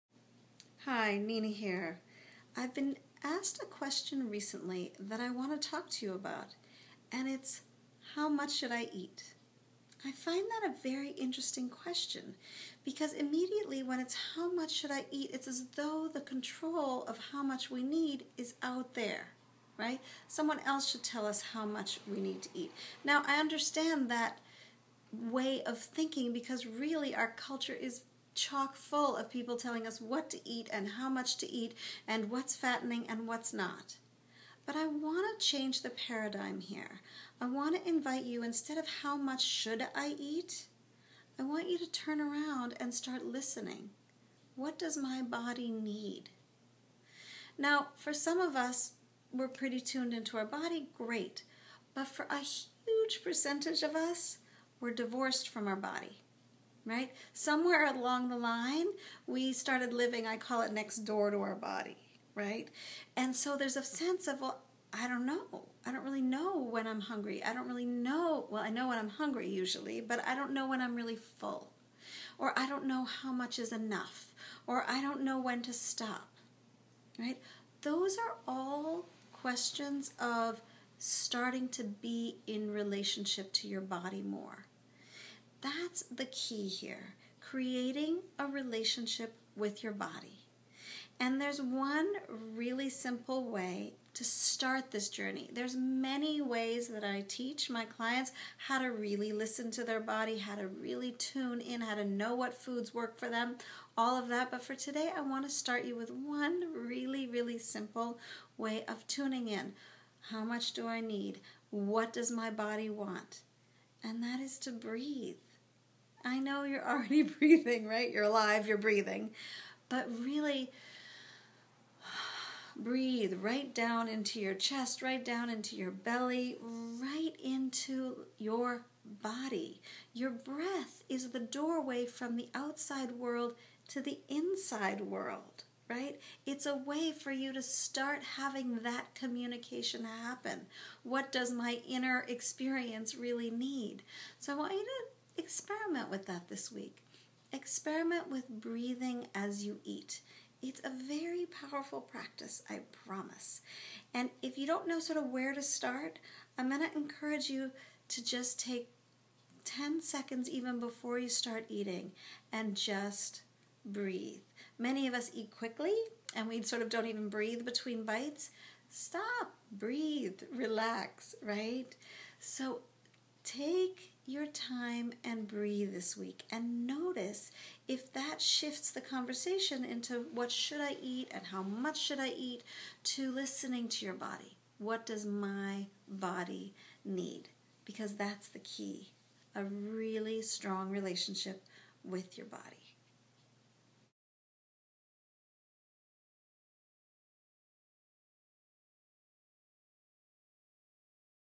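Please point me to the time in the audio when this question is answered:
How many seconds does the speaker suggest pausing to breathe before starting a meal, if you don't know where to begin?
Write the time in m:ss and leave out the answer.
2:39.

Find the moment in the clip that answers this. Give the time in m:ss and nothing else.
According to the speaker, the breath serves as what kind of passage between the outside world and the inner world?
2:11.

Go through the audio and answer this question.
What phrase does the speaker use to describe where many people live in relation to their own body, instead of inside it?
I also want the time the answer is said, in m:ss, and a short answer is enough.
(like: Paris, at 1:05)
next door, at 1:00.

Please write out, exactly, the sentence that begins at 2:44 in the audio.
Many of us eat quickly and we sort of don't even breathe between bites.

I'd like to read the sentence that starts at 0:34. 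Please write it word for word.
But I want to change the paradigm here.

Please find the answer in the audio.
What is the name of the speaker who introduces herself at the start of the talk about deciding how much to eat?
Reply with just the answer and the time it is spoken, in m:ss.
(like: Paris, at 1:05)
Nina, at 0:01.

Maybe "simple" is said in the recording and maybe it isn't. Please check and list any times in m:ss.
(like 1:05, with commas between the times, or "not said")
1:32, 1:47.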